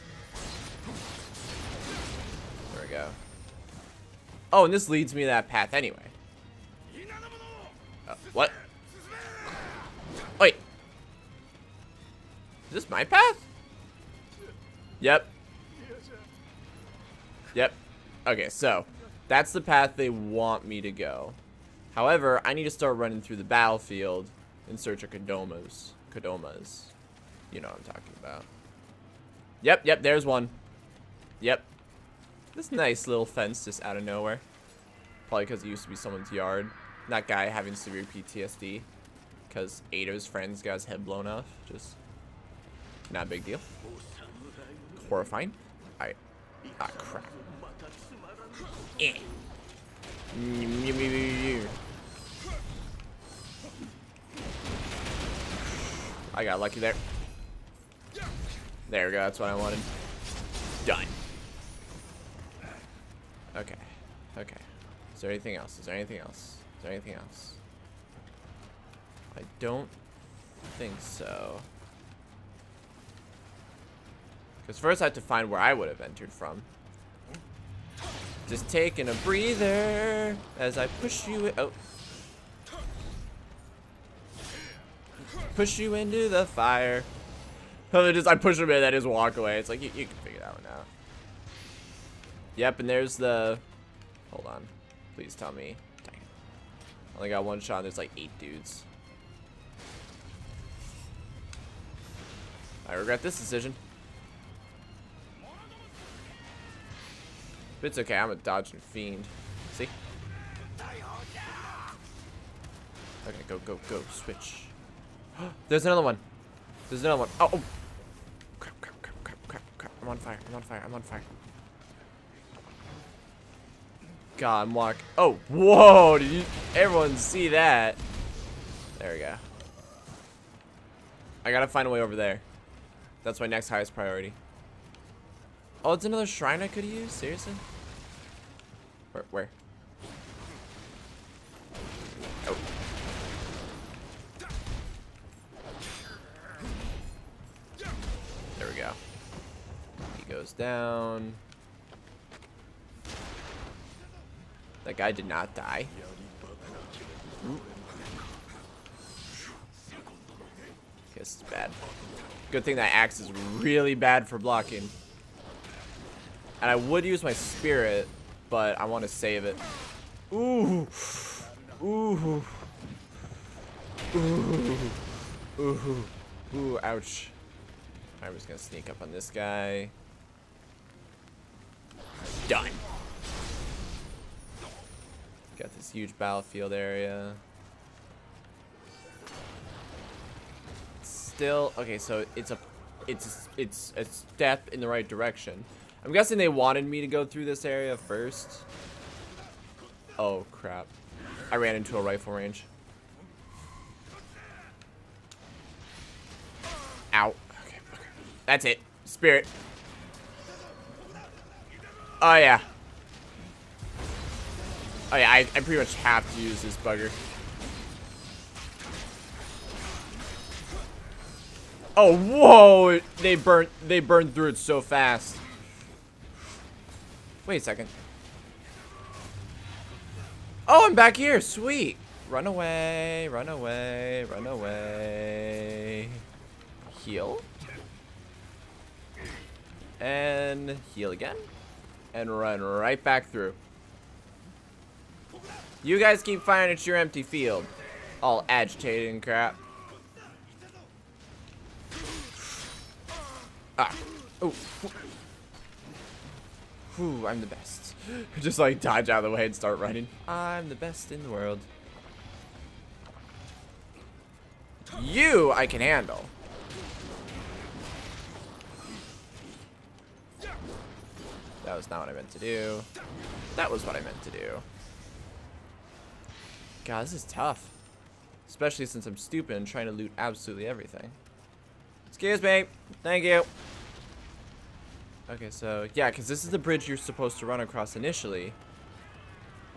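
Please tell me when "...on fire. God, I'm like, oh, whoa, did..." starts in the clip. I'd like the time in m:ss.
2:00.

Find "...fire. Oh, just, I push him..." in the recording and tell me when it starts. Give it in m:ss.
1:26.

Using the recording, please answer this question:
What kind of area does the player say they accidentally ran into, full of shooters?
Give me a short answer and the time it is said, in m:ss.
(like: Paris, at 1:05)
rifle range, at 3:22.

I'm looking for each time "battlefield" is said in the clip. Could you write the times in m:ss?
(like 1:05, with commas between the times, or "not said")
0:23, 3:06.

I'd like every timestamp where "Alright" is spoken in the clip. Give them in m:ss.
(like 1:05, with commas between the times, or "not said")
0:45.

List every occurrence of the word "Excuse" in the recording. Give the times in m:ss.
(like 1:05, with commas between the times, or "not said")
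4:42.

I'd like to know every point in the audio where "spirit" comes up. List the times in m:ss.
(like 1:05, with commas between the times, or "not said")
2:47, 3:29.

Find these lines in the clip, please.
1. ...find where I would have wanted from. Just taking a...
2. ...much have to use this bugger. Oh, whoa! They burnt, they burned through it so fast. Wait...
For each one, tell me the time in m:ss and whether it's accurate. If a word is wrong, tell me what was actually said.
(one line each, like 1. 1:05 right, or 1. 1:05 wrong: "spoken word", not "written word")
1. 1:15 wrong: "entered", not "wanted"
2. 3:35 right.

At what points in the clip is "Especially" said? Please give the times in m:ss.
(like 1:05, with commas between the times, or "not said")
4:38.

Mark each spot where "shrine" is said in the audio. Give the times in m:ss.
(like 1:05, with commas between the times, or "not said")
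2:16.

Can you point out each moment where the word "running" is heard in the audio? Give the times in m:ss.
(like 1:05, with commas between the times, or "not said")
0:22, 4:19.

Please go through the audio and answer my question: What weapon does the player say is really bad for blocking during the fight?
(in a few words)
axe.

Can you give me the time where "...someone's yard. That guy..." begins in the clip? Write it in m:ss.
0:35.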